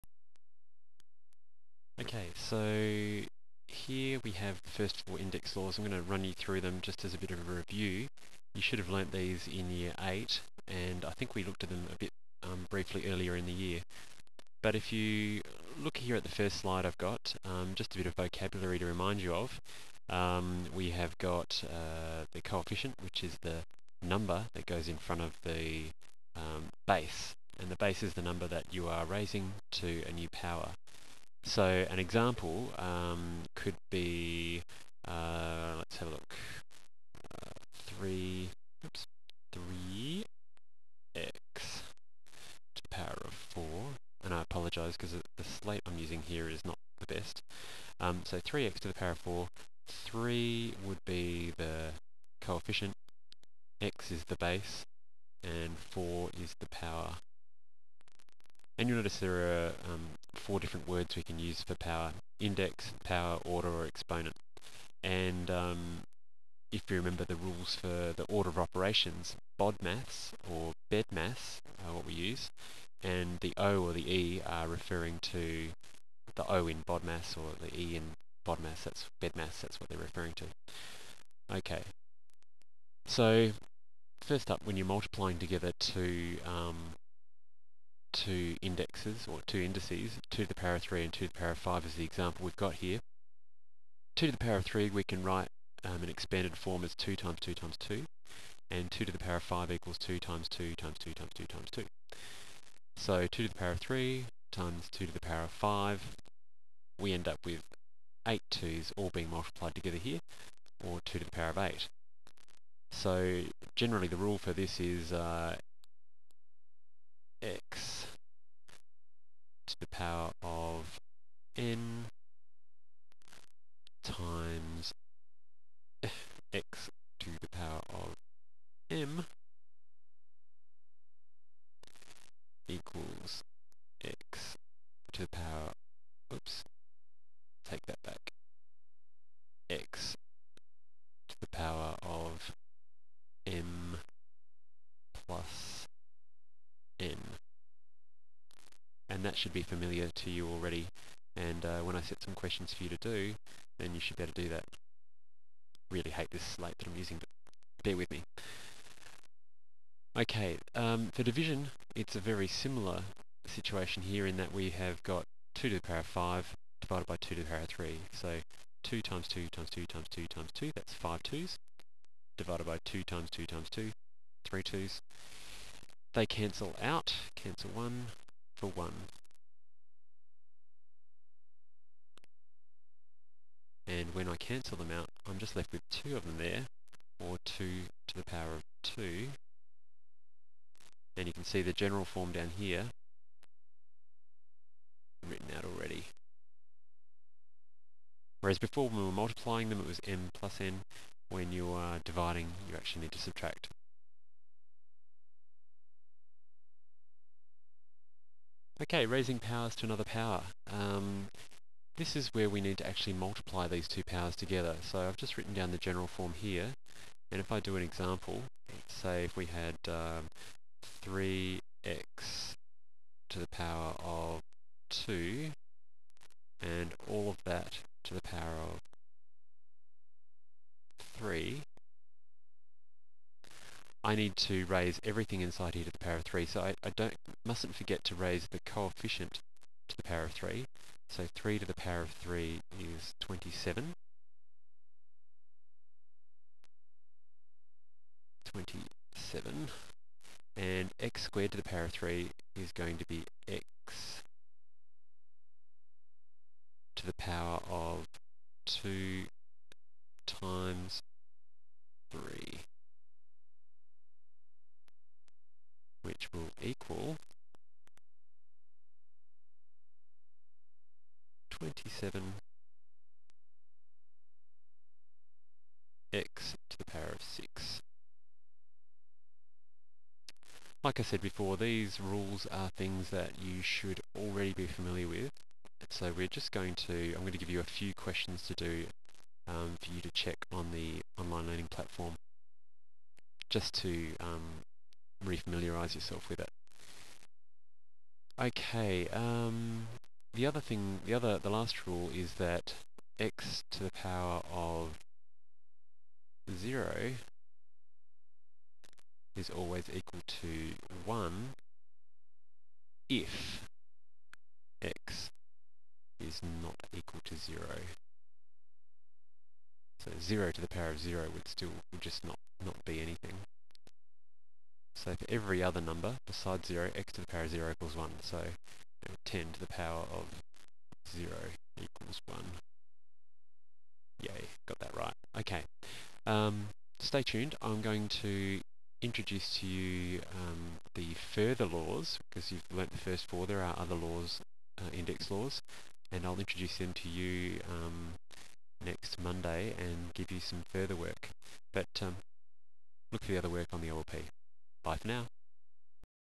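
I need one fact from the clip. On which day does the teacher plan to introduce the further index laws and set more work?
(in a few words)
Monday.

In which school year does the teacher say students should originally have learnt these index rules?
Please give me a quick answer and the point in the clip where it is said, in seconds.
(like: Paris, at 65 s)
year 8, at 9 s.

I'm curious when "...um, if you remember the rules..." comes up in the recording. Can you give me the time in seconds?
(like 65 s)
65 s.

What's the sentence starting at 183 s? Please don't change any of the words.
And when I cancel them out, I'm just left with 2 of them there, or 2 to the power of 2.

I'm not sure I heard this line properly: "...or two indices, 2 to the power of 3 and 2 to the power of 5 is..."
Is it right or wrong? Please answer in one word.
right.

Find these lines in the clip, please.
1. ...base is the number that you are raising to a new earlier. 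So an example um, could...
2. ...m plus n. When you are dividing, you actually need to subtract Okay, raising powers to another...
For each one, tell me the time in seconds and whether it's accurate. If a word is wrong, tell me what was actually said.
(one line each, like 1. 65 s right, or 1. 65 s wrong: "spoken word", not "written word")
1. 27 s wrong: "power", not "earlier"
2. 200 s right.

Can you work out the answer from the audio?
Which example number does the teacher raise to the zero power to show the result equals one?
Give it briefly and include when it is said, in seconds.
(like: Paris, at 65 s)
10, at 329 s.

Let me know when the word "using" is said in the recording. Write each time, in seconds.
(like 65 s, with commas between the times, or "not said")
45 s, 156 s.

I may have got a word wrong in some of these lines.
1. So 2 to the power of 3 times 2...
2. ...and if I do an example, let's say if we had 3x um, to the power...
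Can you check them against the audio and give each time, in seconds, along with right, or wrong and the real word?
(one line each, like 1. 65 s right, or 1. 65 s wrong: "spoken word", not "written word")
1. 102 s right
2. 217 s right.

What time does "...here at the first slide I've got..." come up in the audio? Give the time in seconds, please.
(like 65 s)
15 s.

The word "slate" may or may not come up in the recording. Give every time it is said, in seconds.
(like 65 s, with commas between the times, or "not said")
45 s, 156 s.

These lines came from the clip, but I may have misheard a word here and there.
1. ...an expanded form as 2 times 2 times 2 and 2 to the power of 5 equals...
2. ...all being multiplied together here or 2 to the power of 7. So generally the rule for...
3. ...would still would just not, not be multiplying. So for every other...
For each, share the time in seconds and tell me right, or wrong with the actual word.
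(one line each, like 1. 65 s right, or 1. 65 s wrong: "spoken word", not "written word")
1. 96 s right
2. 108 s wrong: "8", not "7"
3. 321 s wrong: "anything", not "multiplying".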